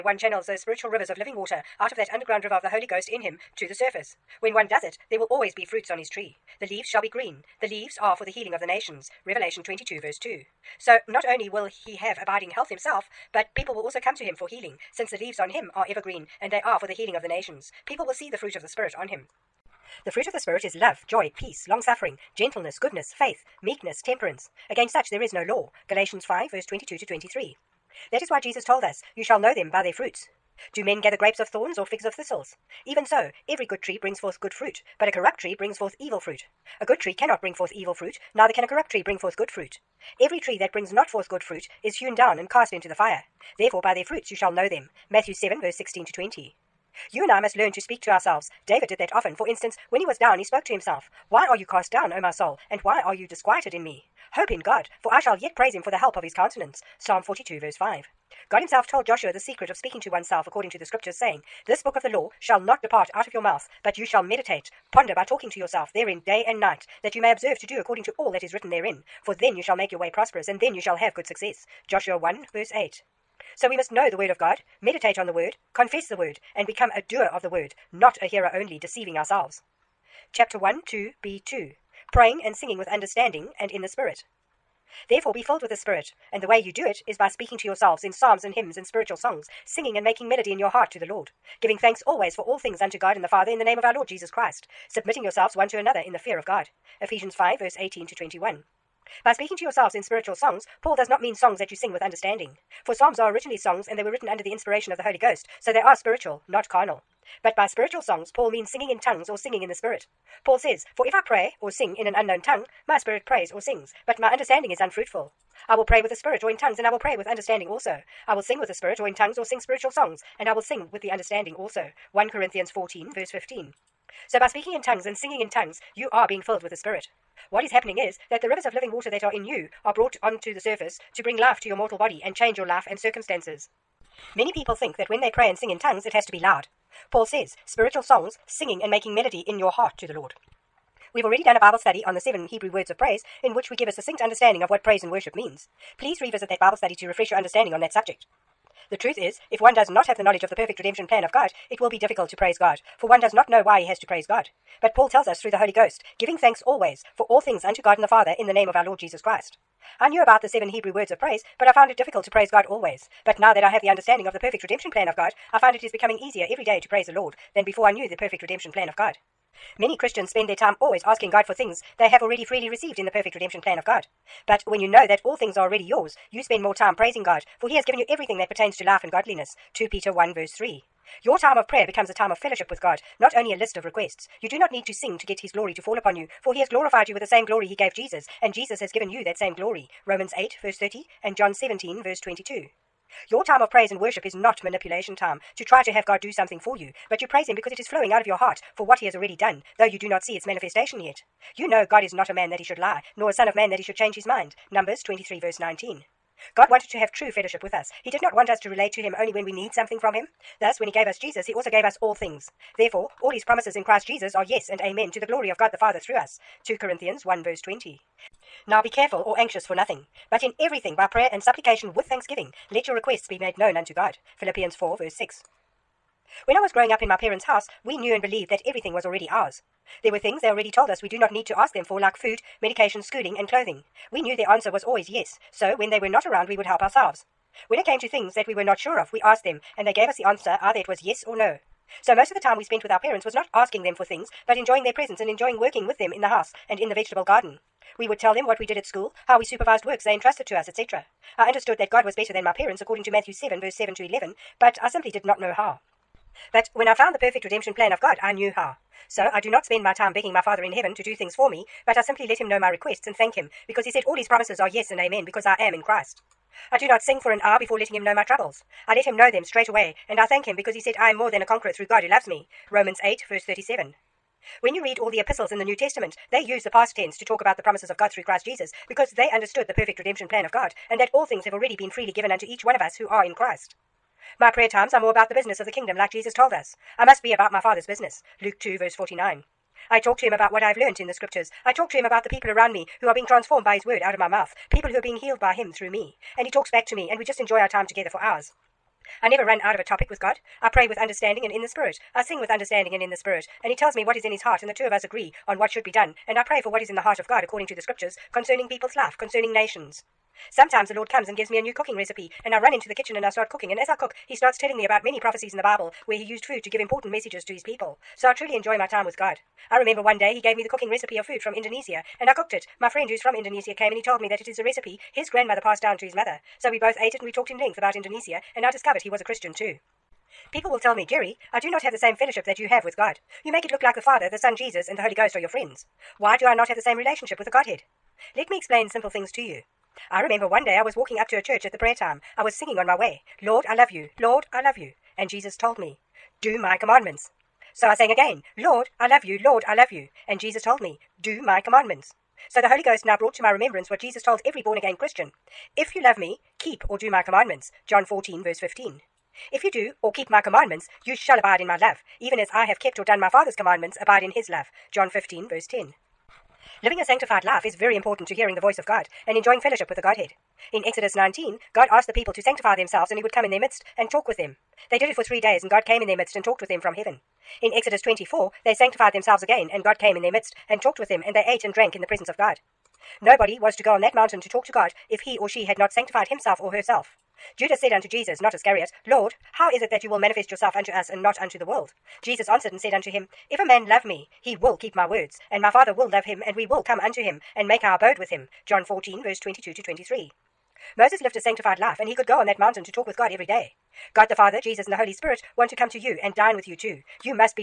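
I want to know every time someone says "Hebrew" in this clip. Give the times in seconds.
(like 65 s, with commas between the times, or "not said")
142 s, 160 s.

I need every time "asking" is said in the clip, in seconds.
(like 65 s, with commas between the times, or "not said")
171 s, 243 s.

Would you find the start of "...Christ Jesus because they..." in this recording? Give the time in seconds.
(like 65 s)
278 s.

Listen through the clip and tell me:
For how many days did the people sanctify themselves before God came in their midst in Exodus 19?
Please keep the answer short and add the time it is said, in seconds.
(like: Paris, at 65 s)
3, at 375 s.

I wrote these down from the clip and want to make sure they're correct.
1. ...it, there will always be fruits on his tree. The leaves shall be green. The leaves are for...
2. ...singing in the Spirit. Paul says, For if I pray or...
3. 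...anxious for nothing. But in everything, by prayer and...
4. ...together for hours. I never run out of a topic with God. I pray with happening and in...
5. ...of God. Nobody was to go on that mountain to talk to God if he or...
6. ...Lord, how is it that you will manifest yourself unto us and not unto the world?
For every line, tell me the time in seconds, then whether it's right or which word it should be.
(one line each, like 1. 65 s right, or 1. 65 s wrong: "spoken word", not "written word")
1. 4 s right
2. 109 s right
3. 219 s right
4. 297 s wrong: "understanding", not "happening"
5. 382 s right
6. 389 s right.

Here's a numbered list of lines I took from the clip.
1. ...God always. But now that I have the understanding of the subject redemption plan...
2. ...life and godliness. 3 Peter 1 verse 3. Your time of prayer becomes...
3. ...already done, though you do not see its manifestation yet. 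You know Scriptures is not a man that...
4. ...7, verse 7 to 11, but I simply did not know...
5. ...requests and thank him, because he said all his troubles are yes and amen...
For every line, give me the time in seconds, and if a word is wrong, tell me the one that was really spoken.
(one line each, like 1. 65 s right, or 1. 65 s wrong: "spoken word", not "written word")
1. 162 s wrong: "perfect", not "subject"
2. 178 s wrong: "2", not "3"
3. 199 s wrong: "God", not "Scriptures"
4. 253 s right
5. 262 s wrong: "promises", not "troubles".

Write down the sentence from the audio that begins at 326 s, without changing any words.
So we both ate it and we talked in length about Indonesia, and I discovered he was a Christian too.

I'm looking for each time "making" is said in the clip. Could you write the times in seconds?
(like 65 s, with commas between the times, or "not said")
90 s, 138 s.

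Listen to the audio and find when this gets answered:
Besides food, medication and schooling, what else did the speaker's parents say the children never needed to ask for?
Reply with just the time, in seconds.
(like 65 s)
233 s.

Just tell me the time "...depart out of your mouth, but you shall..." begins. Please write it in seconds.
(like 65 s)
62 s.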